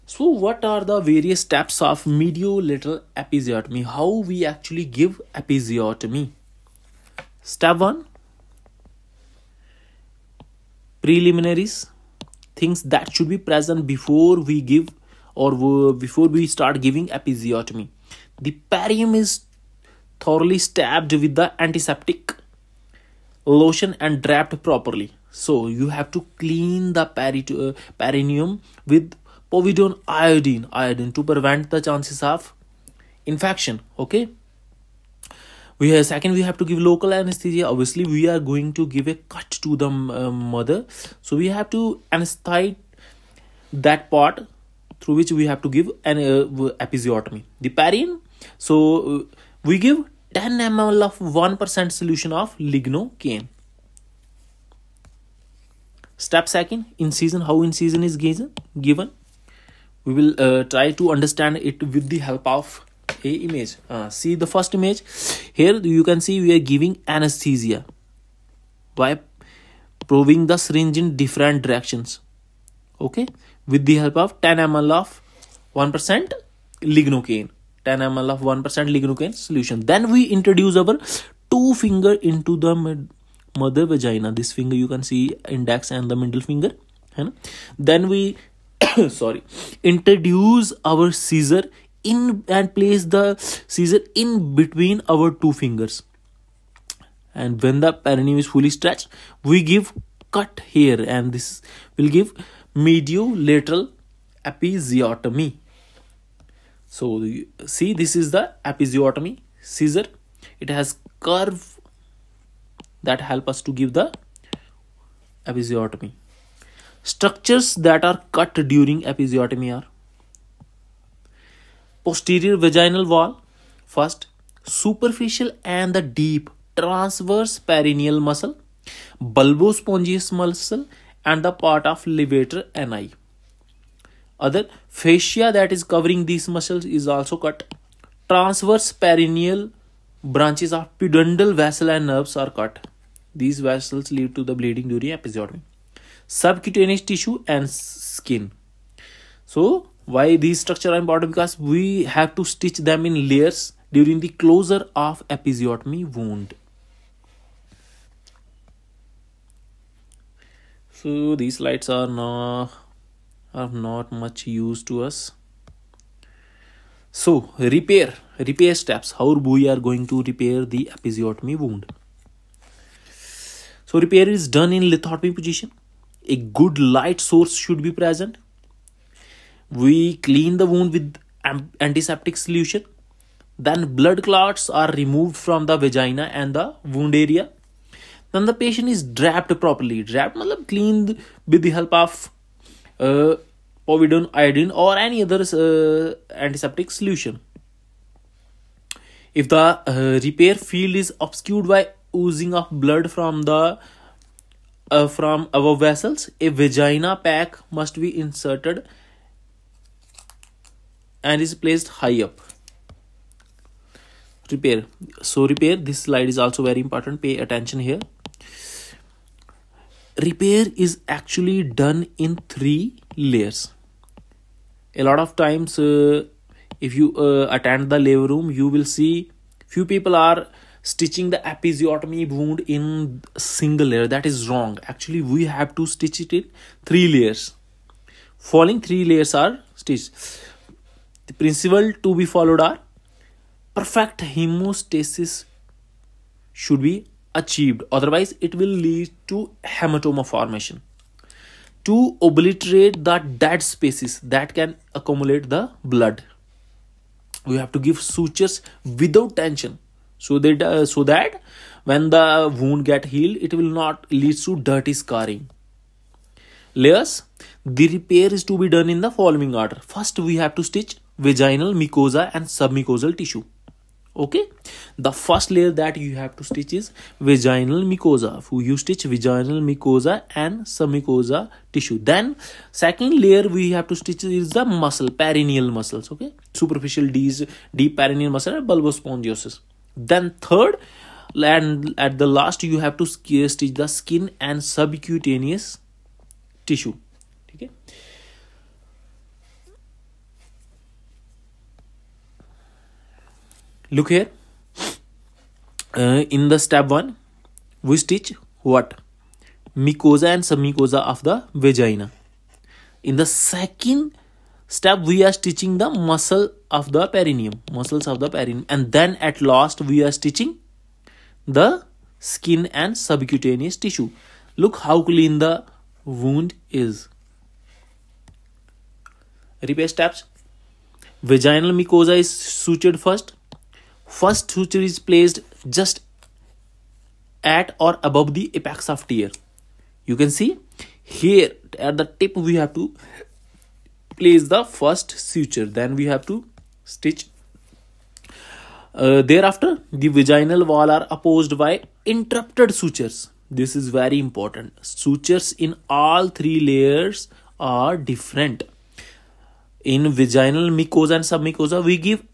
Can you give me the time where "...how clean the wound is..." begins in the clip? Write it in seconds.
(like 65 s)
324 s.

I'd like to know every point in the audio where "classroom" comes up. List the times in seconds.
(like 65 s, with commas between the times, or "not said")
not said.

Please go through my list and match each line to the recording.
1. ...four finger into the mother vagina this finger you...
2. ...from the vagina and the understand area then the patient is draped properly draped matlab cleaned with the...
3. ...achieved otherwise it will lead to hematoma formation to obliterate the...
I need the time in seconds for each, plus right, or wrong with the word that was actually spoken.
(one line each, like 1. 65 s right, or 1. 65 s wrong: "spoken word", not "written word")
1. 81 s wrong: "two", not "four"
2. 185 s wrong: "wound", not "understand"
3. 247 s right.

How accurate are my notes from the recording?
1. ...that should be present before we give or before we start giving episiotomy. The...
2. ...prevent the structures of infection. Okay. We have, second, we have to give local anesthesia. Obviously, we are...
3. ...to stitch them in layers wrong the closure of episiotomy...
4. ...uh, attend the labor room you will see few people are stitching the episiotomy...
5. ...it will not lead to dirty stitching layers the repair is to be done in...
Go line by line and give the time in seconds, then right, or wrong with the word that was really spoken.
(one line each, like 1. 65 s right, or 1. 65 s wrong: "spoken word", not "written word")
1. 12 s right
2. 31 s wrong: "chances", not "structures"
3. 152 s wrong: "during", not "wrong"
4. 227 s right
5. 263 s wrong: "scarring", not "stitching".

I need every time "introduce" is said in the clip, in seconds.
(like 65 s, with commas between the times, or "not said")
80 s, 89 s.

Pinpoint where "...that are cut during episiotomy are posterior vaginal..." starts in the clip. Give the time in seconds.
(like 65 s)
117 s.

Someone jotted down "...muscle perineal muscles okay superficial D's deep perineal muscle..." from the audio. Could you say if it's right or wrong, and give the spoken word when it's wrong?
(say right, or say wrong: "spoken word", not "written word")
right.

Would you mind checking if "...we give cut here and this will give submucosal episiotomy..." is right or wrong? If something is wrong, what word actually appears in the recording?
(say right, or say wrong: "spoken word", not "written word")
wrong: "mediolateral", not "submucosal".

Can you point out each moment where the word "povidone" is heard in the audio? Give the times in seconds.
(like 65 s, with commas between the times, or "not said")
29 s, 193 s.